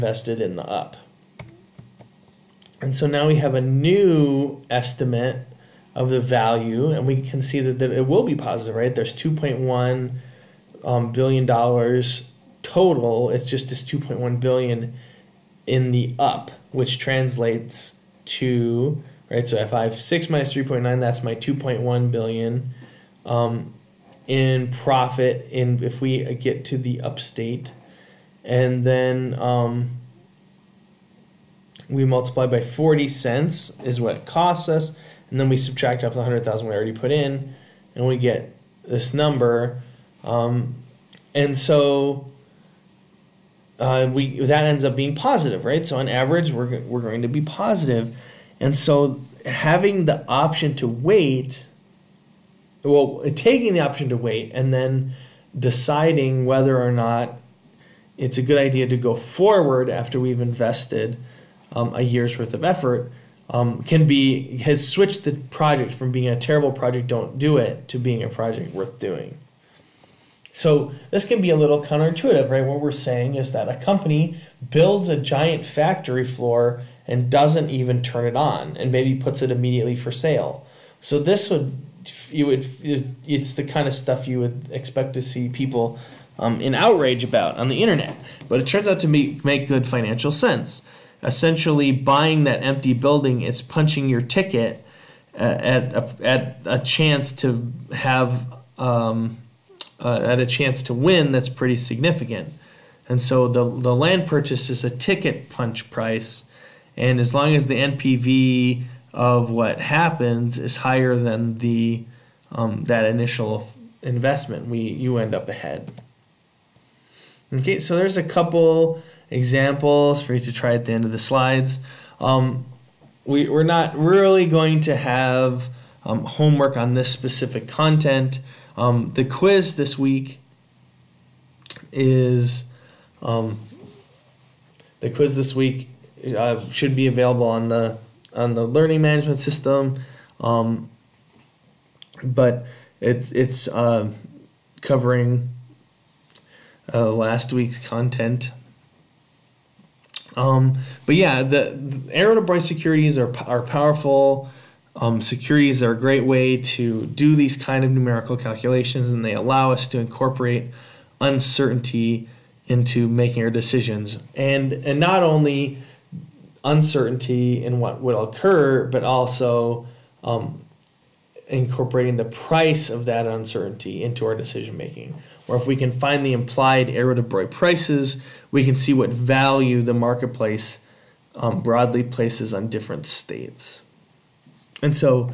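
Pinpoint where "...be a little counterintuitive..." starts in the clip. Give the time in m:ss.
1:11.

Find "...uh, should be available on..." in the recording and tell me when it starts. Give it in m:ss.
2:16.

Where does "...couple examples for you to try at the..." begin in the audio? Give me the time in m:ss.
1:58.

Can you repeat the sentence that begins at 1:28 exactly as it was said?
But it turns out to make, make good financial sense.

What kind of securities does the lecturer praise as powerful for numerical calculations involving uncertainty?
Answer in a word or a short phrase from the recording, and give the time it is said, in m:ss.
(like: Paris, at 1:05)
Arrow-Debreu securities, at 2:32.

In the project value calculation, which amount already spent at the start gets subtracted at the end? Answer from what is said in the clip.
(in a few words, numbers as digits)
100,000.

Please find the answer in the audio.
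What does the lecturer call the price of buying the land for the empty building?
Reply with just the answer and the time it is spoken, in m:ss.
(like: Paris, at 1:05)
ticket punch price, at 1:44.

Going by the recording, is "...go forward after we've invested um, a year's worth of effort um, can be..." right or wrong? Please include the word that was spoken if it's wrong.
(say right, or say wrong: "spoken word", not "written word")
right.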